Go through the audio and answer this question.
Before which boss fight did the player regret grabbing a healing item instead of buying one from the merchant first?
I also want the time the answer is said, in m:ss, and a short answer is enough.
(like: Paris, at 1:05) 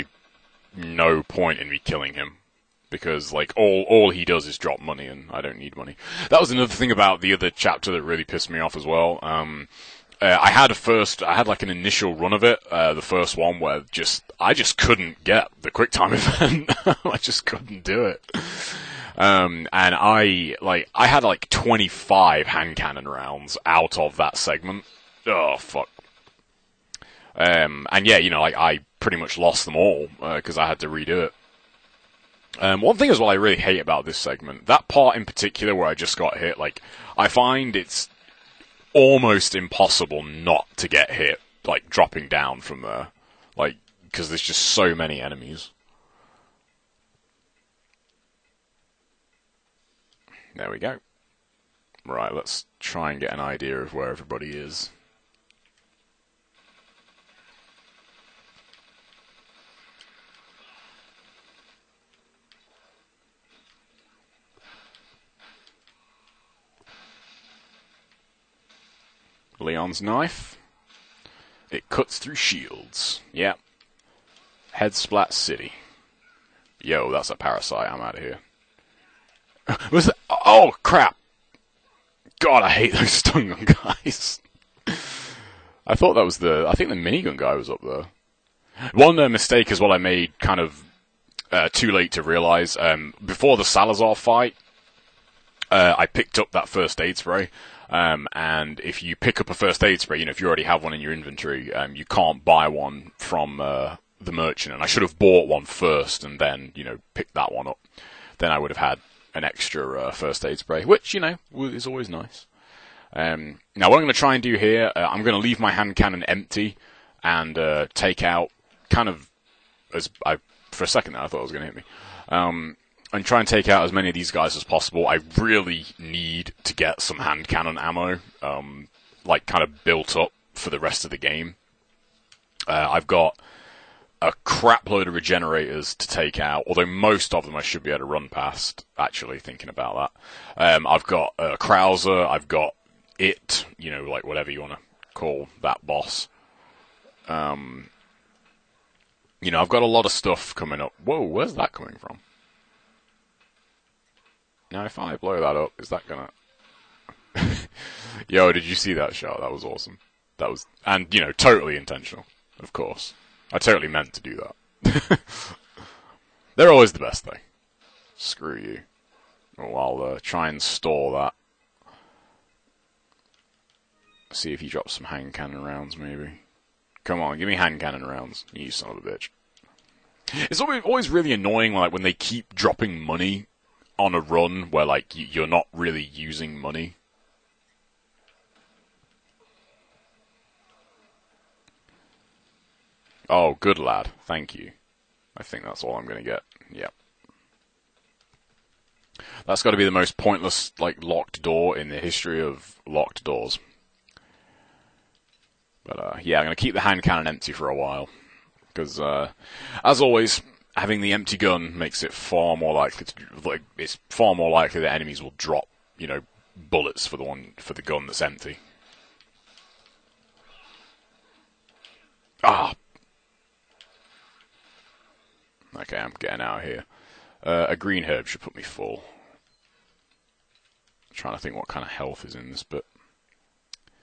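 Salazar, at 1:33.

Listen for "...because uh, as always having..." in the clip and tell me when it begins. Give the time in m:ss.
3:28.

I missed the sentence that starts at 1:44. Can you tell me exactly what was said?
And I should have bought one first and then, you know, picked that one up.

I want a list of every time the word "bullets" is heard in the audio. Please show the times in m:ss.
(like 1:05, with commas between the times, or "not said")
3:36.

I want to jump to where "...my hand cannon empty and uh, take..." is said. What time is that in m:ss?
1:55.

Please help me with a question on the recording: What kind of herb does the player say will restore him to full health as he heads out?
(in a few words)
Green herb.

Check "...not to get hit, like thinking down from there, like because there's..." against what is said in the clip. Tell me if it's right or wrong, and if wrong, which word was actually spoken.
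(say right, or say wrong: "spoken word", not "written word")
wrong: "dropping", not "thinking".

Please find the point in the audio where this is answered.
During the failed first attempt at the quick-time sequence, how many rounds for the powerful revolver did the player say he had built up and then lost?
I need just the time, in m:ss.
0:21.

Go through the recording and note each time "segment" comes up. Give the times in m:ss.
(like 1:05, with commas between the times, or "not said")
0:24, 0:34.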